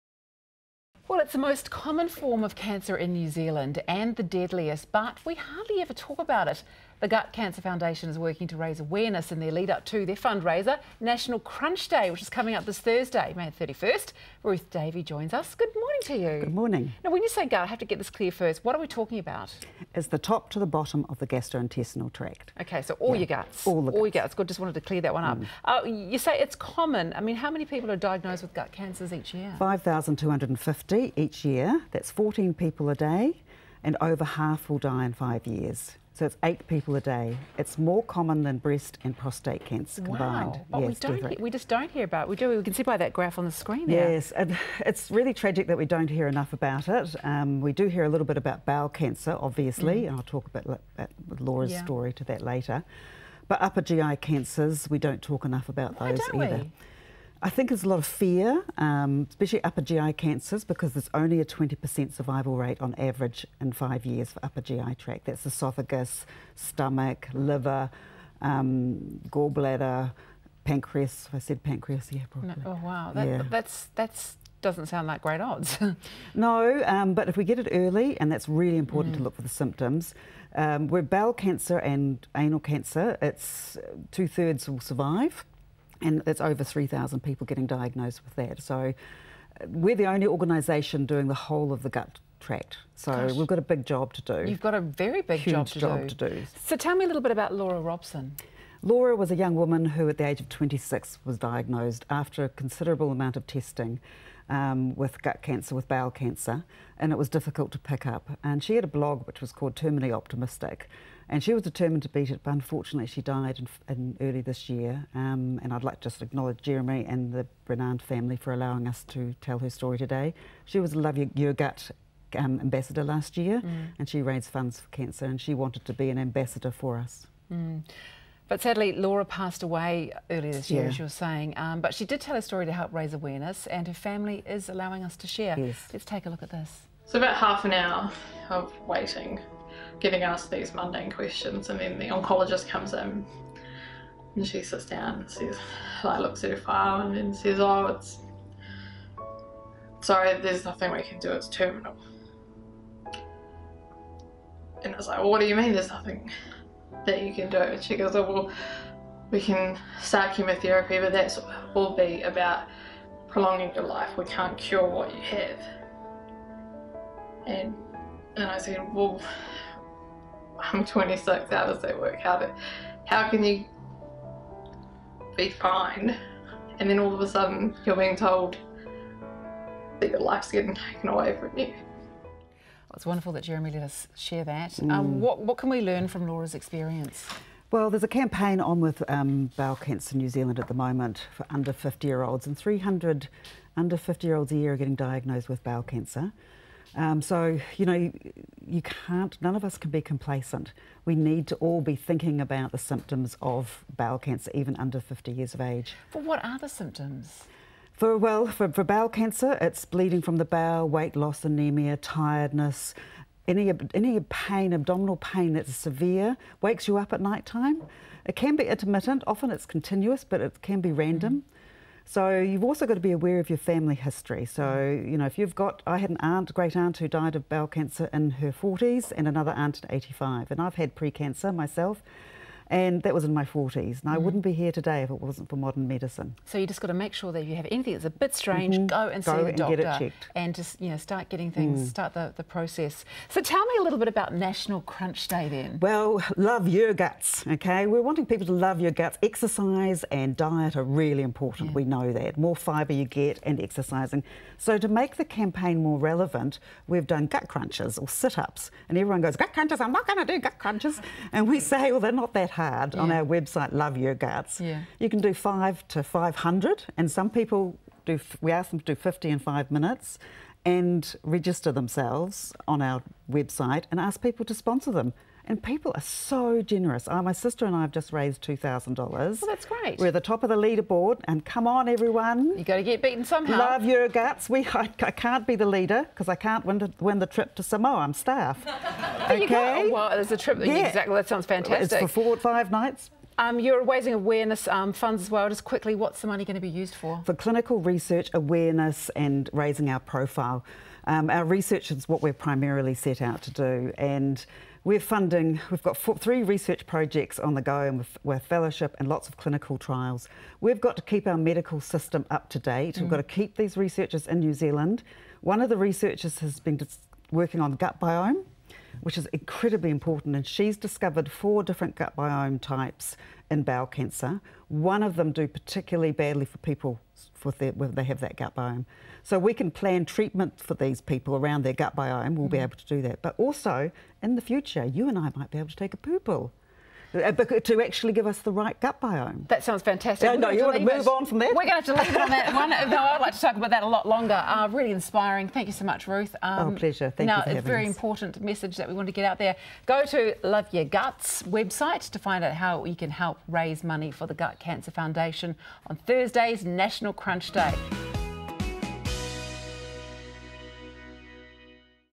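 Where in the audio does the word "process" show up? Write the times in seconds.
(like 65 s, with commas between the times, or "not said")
242 s.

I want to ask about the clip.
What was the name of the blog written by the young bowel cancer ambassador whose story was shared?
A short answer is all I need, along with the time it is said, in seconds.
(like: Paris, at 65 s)
Terminally Optimistic, at 109 s.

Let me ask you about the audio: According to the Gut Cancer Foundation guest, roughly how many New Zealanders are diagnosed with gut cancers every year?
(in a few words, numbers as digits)
5,250.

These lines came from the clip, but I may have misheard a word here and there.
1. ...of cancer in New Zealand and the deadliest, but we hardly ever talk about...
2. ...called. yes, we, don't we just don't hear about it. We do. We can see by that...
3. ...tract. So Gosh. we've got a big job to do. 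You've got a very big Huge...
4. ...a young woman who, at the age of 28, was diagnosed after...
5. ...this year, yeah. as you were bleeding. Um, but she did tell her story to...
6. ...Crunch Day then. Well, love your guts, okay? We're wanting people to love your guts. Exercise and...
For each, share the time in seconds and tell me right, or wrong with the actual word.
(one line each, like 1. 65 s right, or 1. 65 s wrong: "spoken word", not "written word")
1. 2 s right
2. 40 s wrong: "combined", not "called"
3. 92 s right
4. 99 s wrong: "26", not "28"
5. 130 s wrong: "saying", not "bleeding"
6. 244 s right.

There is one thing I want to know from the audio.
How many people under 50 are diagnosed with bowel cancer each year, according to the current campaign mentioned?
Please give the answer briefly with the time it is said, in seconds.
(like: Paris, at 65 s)
300, at 192 s.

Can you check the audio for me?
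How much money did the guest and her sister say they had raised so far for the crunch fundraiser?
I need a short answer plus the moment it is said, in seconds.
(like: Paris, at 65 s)
$2,000, at 278 s.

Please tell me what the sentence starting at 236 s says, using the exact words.
So you just got to make sure that if you have anything that's a bit strange, mm -hmm.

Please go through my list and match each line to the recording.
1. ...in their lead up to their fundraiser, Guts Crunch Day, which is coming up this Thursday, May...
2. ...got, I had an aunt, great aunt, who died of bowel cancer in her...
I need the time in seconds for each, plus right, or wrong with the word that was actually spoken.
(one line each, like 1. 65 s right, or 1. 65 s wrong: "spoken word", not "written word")
1. 9 s wrong: "National", not "Guts"
2. 225 s right.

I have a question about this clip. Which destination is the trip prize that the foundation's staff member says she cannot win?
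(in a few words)
Samoa.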